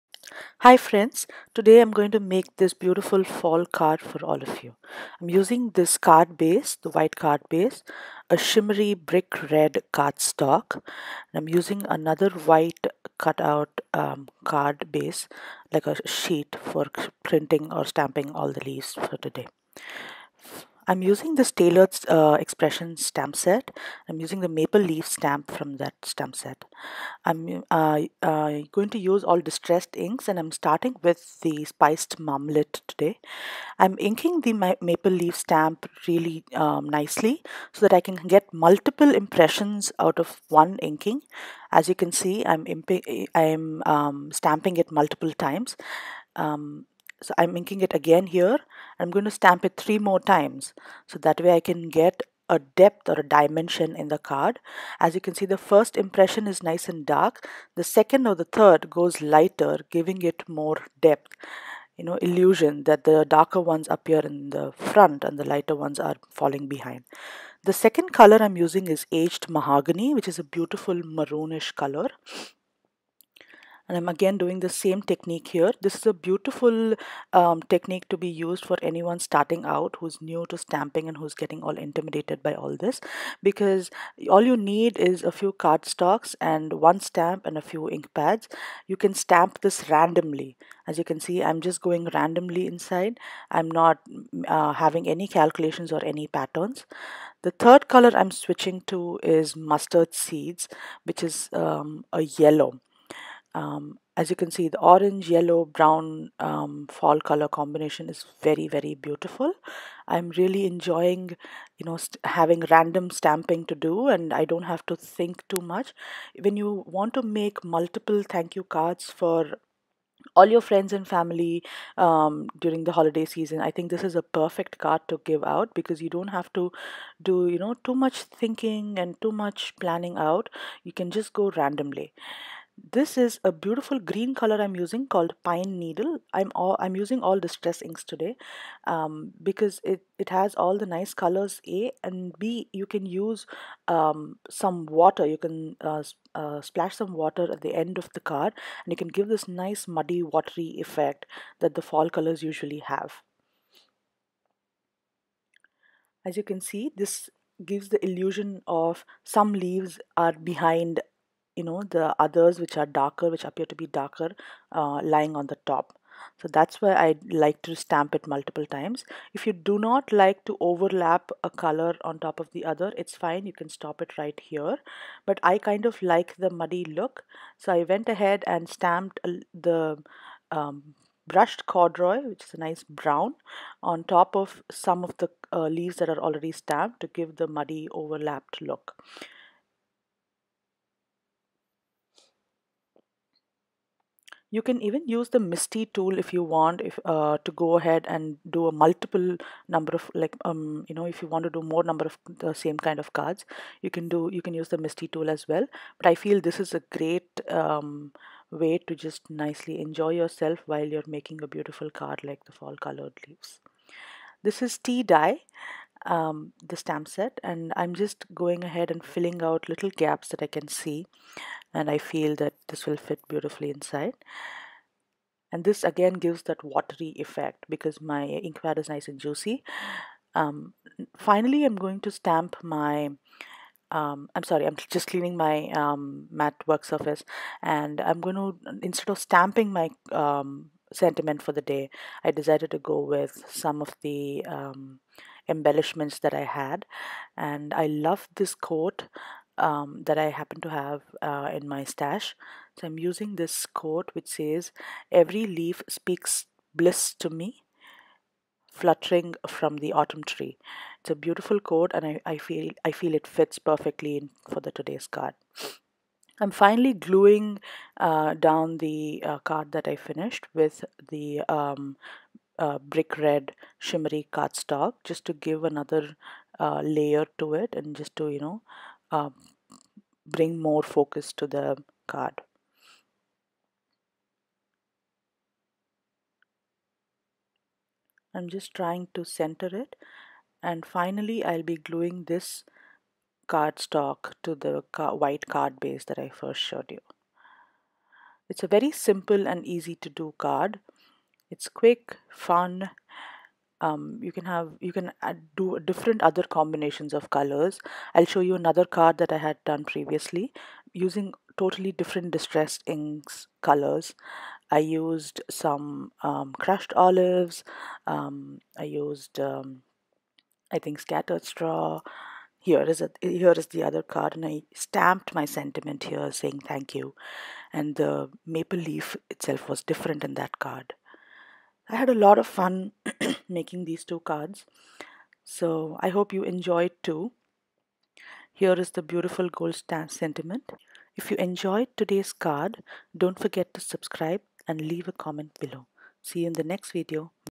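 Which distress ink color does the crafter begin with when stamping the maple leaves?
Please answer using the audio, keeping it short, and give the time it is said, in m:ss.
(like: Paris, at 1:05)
Spiced Marmalade, at 0:31.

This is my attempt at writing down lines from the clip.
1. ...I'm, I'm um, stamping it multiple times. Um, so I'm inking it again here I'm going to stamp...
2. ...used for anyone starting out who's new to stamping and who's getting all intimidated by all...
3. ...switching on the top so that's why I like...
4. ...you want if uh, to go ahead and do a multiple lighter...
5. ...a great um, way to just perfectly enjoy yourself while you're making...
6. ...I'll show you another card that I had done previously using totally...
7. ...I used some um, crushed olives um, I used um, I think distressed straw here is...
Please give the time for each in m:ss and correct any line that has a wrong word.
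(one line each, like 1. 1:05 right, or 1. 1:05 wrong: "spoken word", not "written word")
1. 0:42 right
2. 1:18 right
3. 2:45 wrong: "lying", not "switching"
4. 3:16 wrong: "number", not "lighter"
5. 3:26 wrong: "nicely", not "perfectly"
6. 5:08 right
7. 5:14 wrong: "scattered", not "distressed".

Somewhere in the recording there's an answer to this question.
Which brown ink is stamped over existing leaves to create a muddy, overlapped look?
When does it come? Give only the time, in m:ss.
3:01.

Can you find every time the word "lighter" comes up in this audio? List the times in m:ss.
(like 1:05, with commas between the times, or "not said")
0:59, 1:05.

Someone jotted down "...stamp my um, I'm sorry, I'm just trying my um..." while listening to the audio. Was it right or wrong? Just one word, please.
wrong.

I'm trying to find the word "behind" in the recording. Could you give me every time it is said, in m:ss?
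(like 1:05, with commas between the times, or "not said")
1:06, 2:40.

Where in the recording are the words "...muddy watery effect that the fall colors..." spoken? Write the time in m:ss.
2:29.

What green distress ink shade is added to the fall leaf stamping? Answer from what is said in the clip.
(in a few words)
Pine Needle.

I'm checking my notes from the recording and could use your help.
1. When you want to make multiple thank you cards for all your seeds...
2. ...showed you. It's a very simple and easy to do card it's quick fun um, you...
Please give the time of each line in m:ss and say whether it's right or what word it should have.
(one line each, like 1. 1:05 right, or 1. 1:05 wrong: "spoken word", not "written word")
1. 1:56 wrong: "friends", not "seeds"
2. 4:56 right.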